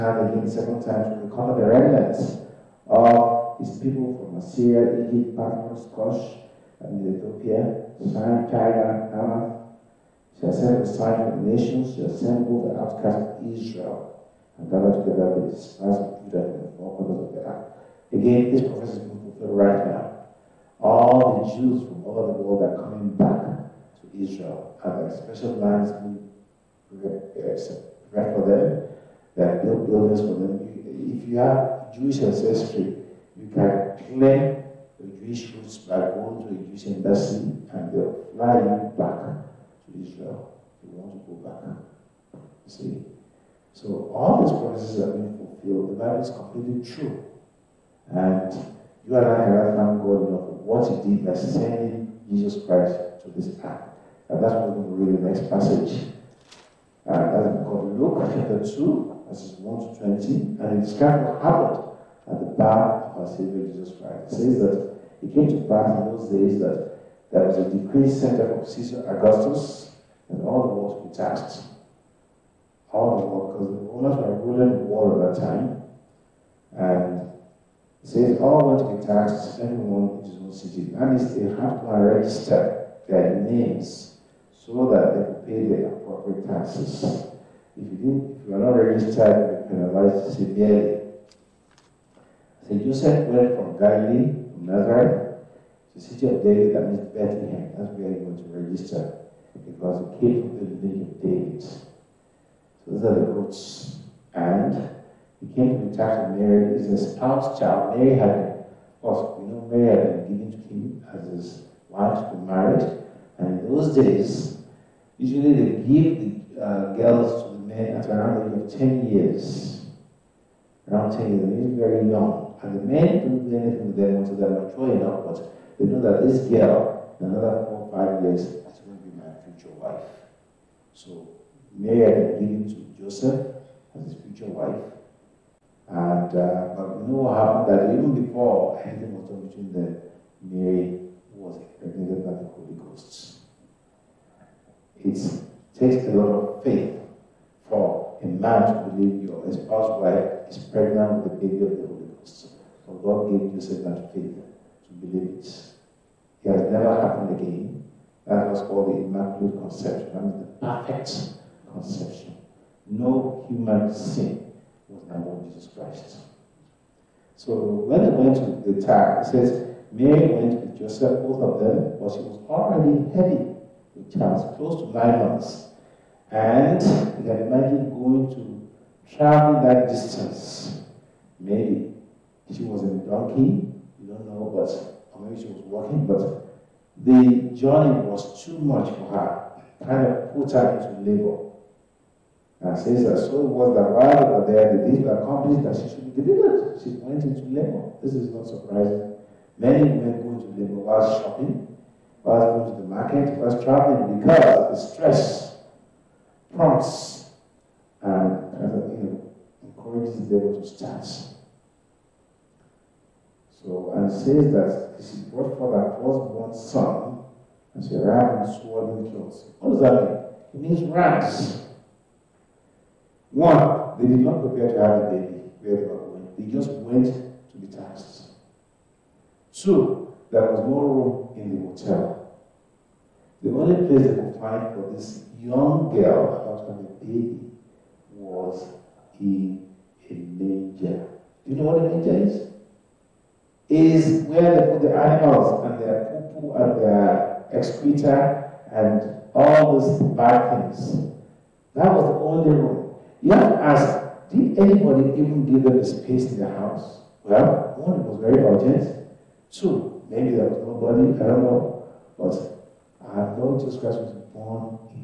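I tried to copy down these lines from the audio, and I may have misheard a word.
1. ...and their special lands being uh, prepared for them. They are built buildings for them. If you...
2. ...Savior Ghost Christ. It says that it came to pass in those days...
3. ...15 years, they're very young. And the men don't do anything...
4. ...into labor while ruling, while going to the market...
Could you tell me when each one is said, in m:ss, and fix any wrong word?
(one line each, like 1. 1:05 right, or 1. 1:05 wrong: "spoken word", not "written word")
1. 0:24 right
2. 1:03 wrong: "Jesus", not "Ghost"
3. 2:01 wrong: "10", not "15"
4. 3:20 wrong: "shopping", not "ruling".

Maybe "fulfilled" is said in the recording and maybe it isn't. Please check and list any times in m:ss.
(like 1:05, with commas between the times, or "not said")
0:19, 0:45.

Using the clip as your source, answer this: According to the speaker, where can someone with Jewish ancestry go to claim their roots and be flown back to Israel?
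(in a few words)
A Jewish embassy.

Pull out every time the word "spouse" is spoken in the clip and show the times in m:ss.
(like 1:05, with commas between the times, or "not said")
1:47, 2:29.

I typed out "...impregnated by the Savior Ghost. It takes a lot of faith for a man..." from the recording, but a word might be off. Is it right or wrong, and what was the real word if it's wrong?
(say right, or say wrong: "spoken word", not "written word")
wrong: "Holy", not "Savior".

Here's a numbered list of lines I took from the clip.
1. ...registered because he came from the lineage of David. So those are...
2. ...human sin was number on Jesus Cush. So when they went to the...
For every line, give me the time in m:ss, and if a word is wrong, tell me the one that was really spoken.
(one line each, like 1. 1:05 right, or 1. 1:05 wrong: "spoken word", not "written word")
1. 1:38 right
2. 2:43 wrong: "Christ", not "Cush".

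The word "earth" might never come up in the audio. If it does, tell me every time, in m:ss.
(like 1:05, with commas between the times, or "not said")
0:17, 0:53.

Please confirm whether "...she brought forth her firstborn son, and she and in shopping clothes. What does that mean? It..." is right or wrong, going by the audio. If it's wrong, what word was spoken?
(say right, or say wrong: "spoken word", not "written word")
wrong: "swaddling", not "shopping".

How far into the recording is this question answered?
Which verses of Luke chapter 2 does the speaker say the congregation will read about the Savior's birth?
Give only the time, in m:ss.
0:59.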